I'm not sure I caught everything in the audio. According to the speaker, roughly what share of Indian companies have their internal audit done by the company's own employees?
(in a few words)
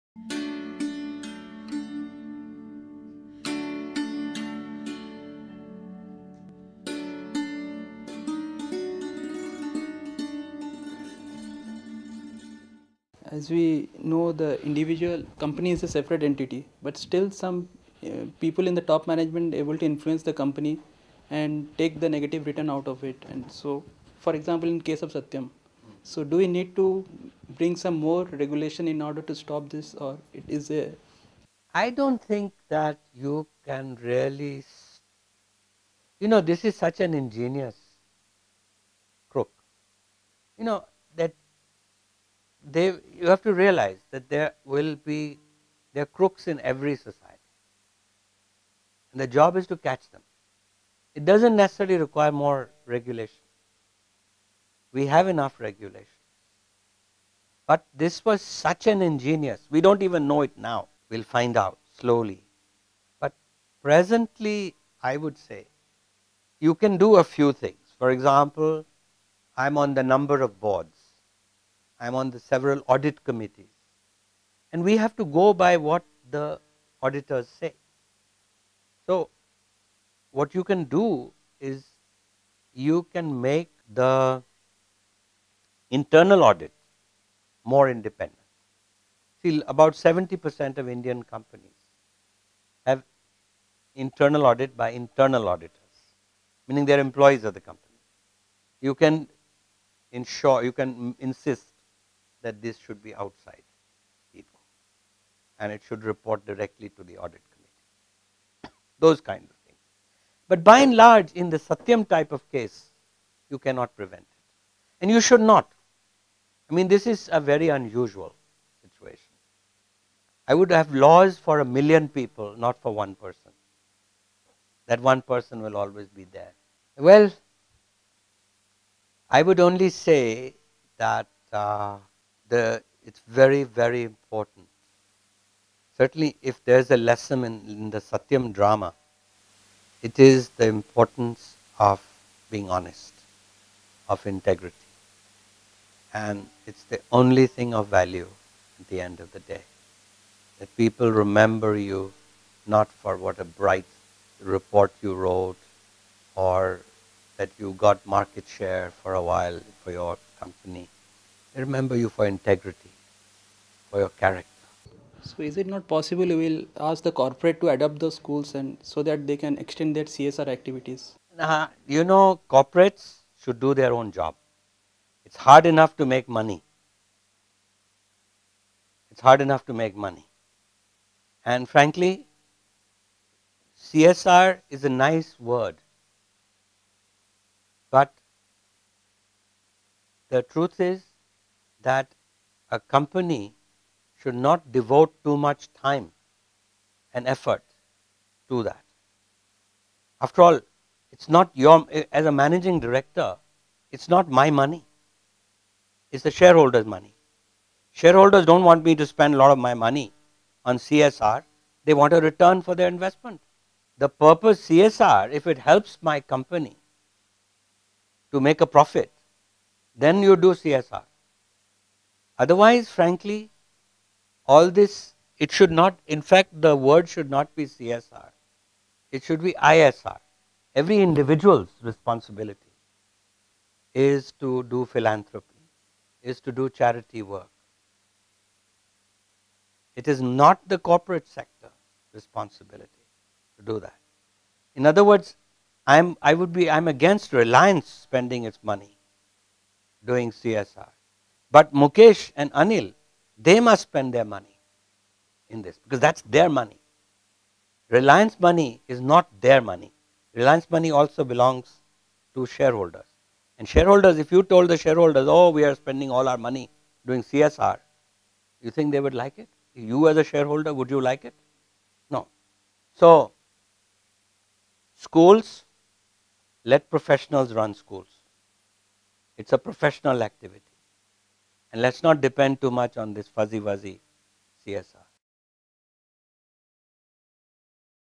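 70%.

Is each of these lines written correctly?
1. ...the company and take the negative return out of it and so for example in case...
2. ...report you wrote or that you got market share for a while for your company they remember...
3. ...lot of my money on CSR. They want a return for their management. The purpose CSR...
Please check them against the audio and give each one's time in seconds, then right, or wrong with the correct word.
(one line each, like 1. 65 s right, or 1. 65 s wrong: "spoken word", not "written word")
1. 20 s right
2. 154 s right
3. 209 s wrong: "investment", not "management".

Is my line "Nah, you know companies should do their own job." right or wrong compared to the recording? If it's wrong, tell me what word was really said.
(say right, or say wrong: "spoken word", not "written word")
wrong: "corporates", not "companies".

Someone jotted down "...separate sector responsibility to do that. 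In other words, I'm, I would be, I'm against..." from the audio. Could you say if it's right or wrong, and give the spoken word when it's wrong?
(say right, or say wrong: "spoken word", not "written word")
wrong: "corporate", not "separate".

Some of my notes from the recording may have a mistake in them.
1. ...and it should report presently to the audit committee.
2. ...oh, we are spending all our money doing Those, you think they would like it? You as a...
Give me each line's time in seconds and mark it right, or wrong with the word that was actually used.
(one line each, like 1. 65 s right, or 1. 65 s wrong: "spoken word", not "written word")
1. 105 s wrong: "directly", not "presently"
2. 265 s wrong: "CSR", not "Those".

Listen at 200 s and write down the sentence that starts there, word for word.
After all, it's not your, as a managing director, it's not my money.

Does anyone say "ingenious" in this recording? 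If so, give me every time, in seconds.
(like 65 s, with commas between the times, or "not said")
37 s, 59 s.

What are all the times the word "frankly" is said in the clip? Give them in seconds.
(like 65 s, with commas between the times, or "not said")
181 s, 222 s.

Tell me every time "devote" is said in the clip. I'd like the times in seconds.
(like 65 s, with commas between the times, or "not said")
194 s.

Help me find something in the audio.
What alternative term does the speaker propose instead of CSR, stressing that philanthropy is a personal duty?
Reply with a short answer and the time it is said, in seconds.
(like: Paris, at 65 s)
ISR, at 229 s.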